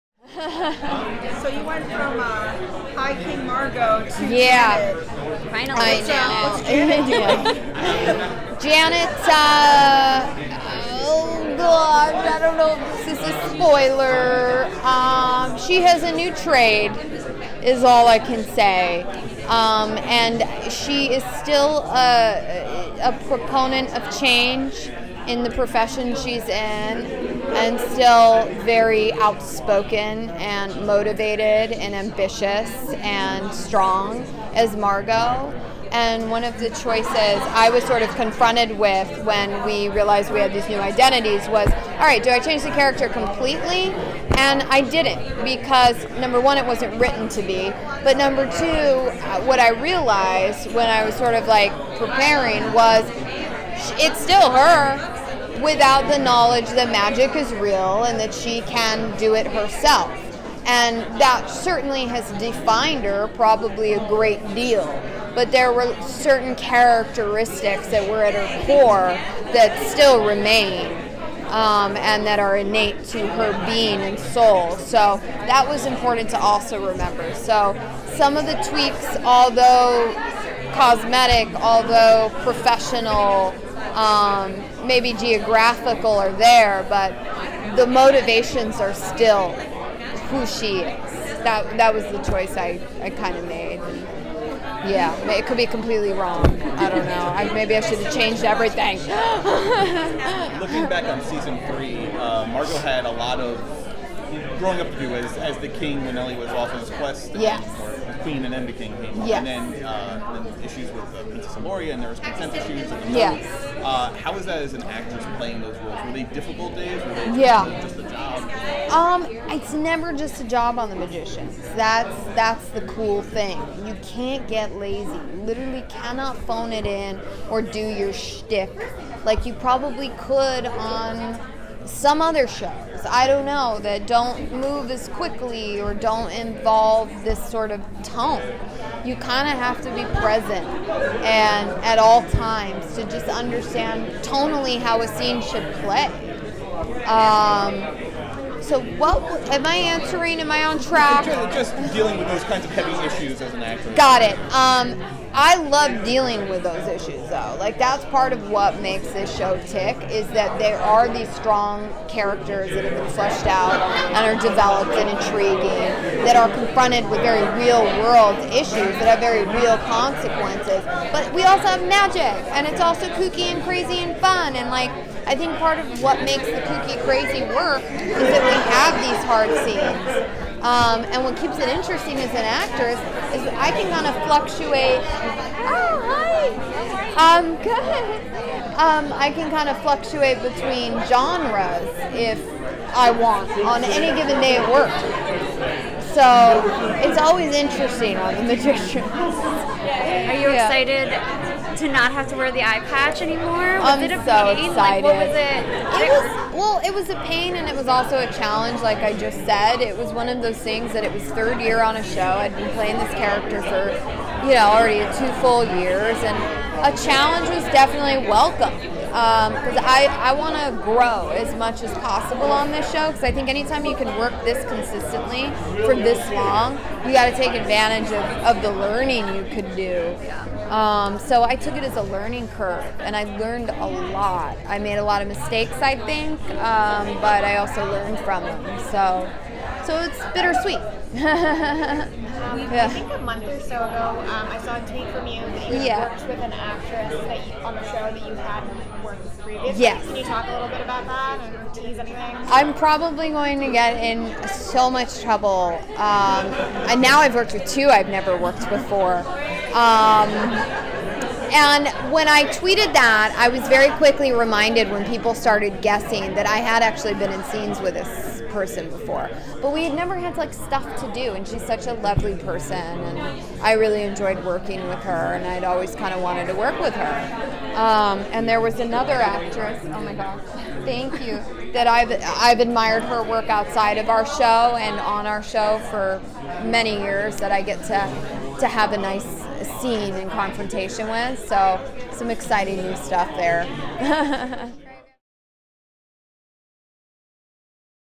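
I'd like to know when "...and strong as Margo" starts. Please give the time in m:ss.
0:32.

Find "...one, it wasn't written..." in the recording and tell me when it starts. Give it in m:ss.
0:46.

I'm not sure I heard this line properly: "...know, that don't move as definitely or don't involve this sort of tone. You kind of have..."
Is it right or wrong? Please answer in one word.
wrong.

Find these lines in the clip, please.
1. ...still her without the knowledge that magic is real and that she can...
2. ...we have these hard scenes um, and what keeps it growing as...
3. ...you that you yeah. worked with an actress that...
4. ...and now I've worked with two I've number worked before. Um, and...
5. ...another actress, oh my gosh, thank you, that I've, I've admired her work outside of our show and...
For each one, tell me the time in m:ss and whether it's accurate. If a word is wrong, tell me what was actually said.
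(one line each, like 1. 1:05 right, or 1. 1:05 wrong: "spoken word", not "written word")
1. 0:54 right
2. 2:58 wrong: "interesting", not "growing"
3. 4:05 right
4. 4:16 wrong: "never", not "number"
5. 4:38 right.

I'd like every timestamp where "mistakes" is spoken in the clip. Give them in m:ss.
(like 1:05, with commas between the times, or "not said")
3:55.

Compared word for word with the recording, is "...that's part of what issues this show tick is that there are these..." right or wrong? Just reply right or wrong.
wrong.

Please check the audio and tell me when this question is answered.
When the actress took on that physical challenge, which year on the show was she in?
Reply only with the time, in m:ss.
3:31.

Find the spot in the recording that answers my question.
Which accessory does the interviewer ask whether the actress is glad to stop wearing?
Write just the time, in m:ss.
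3:22.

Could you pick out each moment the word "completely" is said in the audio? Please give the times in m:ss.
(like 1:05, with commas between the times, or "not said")
0:43, 1:35.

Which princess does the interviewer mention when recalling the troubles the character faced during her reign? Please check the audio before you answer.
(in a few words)
Princess Amoria.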